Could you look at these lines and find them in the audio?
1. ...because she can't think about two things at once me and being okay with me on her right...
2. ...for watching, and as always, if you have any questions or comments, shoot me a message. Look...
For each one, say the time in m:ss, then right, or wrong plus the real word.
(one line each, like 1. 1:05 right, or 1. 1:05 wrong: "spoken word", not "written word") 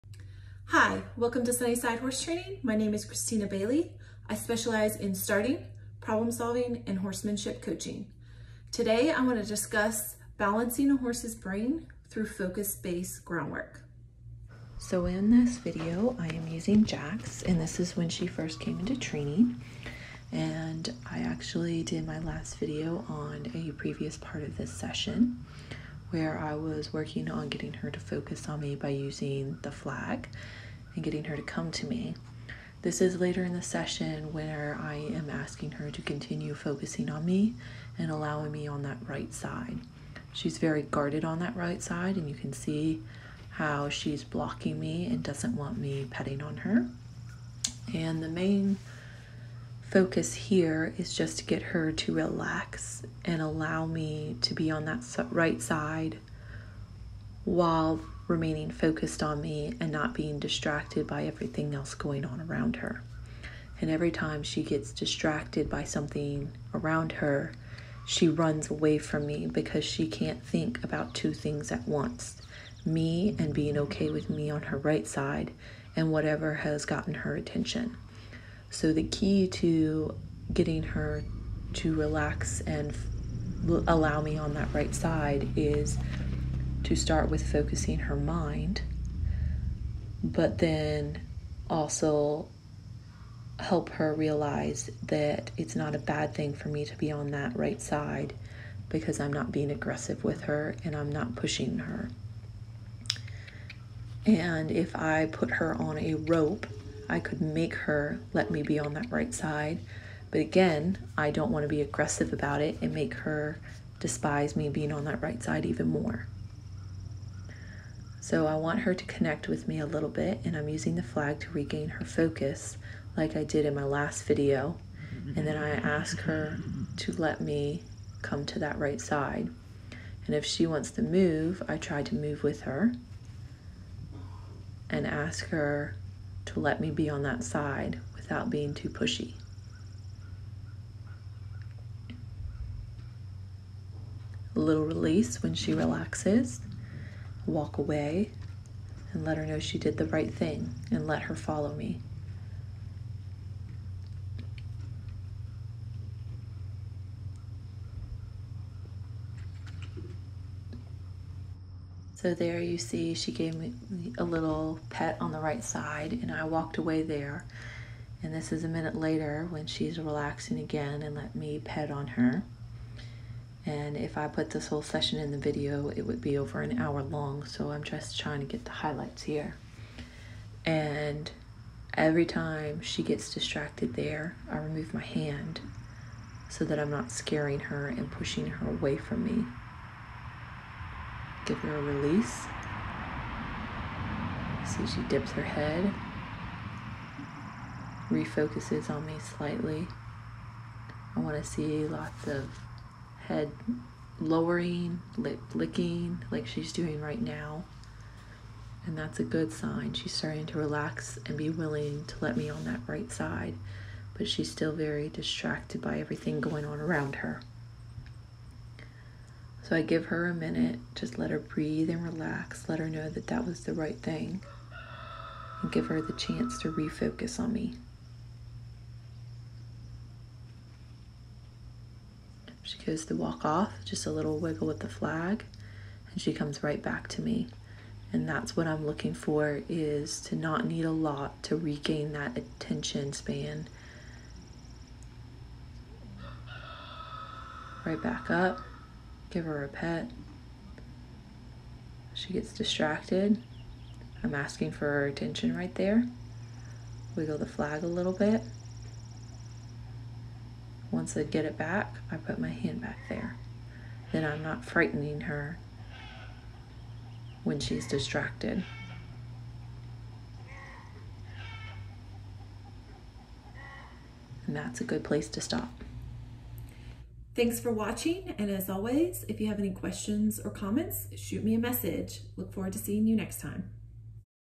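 1. 1:09 right
2. 4:37 right.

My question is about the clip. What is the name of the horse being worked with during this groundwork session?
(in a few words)
Jax.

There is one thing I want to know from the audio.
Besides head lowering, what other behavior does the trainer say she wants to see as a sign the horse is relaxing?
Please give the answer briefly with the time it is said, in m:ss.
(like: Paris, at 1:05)
lip licking, at 3:25.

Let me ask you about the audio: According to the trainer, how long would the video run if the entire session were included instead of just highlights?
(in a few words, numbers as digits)
over an hour.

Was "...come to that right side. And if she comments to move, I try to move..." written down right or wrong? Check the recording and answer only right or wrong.
wrong.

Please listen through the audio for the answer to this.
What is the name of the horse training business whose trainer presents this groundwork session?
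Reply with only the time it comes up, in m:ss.
0:01.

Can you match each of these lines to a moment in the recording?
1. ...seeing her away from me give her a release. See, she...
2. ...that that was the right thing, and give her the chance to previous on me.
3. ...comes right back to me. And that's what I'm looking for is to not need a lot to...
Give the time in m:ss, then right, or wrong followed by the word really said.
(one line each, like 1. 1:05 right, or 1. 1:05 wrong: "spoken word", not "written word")
1. 3:08 wrong: "pushing", not "seeing"
2. 3:43 wrong: "refocus", not "previous"
3. 3:56 right.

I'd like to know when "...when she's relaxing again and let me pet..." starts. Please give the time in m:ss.
2:49.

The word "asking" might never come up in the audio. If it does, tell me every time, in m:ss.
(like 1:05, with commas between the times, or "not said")
0:35, 4:14.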